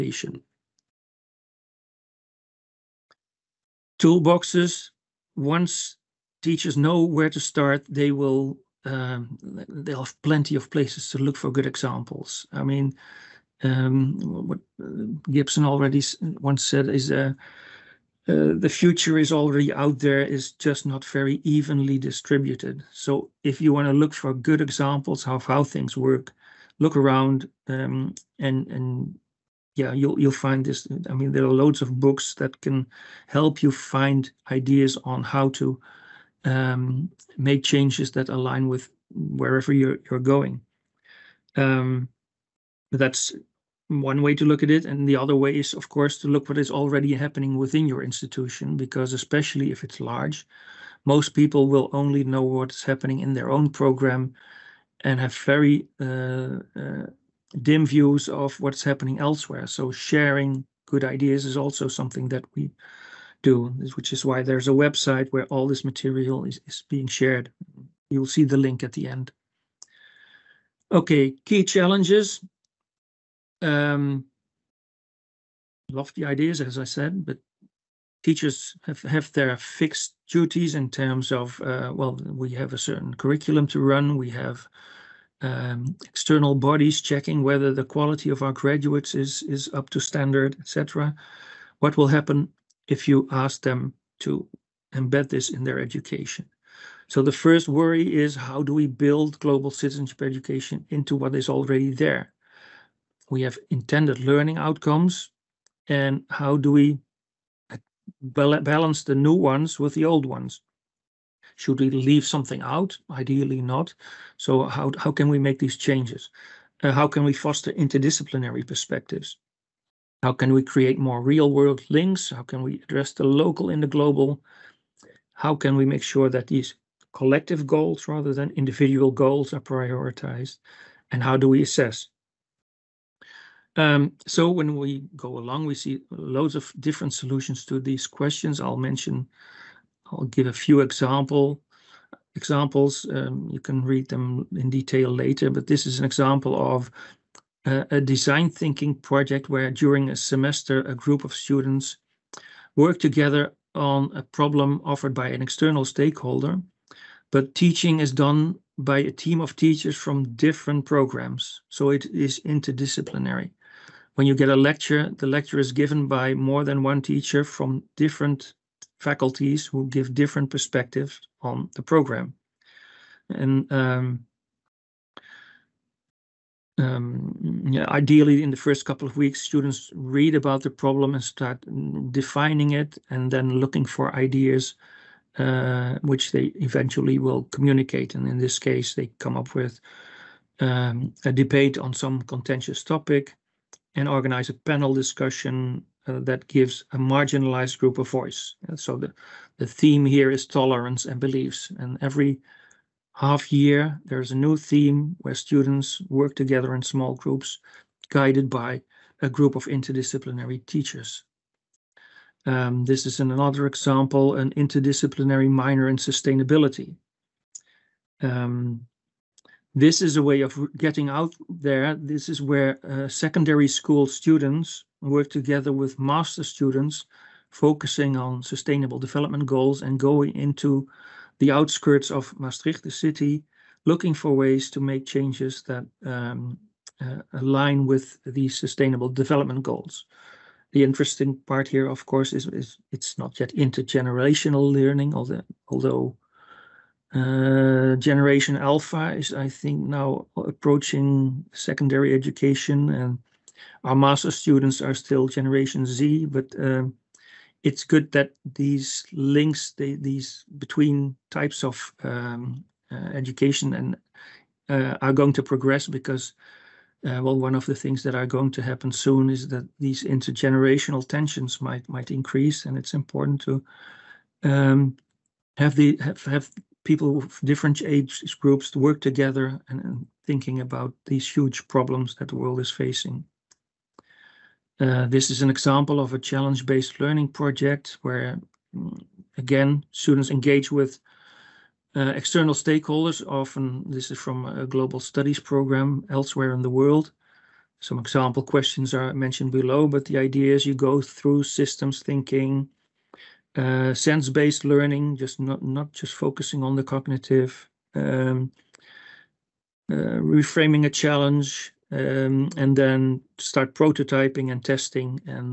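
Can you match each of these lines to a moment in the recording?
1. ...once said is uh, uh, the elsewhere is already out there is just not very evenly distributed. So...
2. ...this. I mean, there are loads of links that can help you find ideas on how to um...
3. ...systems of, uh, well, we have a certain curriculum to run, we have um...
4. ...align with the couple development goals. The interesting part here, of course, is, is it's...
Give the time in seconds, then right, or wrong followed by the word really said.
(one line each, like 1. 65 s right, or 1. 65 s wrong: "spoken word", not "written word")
1. 16 s wrong: "future", not "elsewhere"
2. 30 s wrong: "books", not "links"
3. 80 s wrong: "terms", not "systems"
4. 237 s wrong: "sustainable", not "couple".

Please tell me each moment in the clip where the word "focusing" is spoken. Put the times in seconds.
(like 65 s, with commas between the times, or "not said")
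227 s, 306 s.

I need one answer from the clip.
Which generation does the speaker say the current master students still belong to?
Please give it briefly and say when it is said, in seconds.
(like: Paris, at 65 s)
Generation Z, at 255 s.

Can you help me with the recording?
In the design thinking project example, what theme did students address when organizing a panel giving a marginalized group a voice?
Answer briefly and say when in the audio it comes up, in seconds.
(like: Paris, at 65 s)
Tolerance and beliefs, at 200 s.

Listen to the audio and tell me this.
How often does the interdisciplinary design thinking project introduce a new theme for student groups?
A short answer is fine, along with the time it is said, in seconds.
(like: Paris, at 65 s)
Every half year, at 202 s.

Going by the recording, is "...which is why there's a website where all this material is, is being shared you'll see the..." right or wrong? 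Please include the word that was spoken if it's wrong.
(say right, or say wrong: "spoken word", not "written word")
right.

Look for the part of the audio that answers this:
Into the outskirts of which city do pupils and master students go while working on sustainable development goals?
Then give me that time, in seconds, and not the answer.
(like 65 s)
232 s.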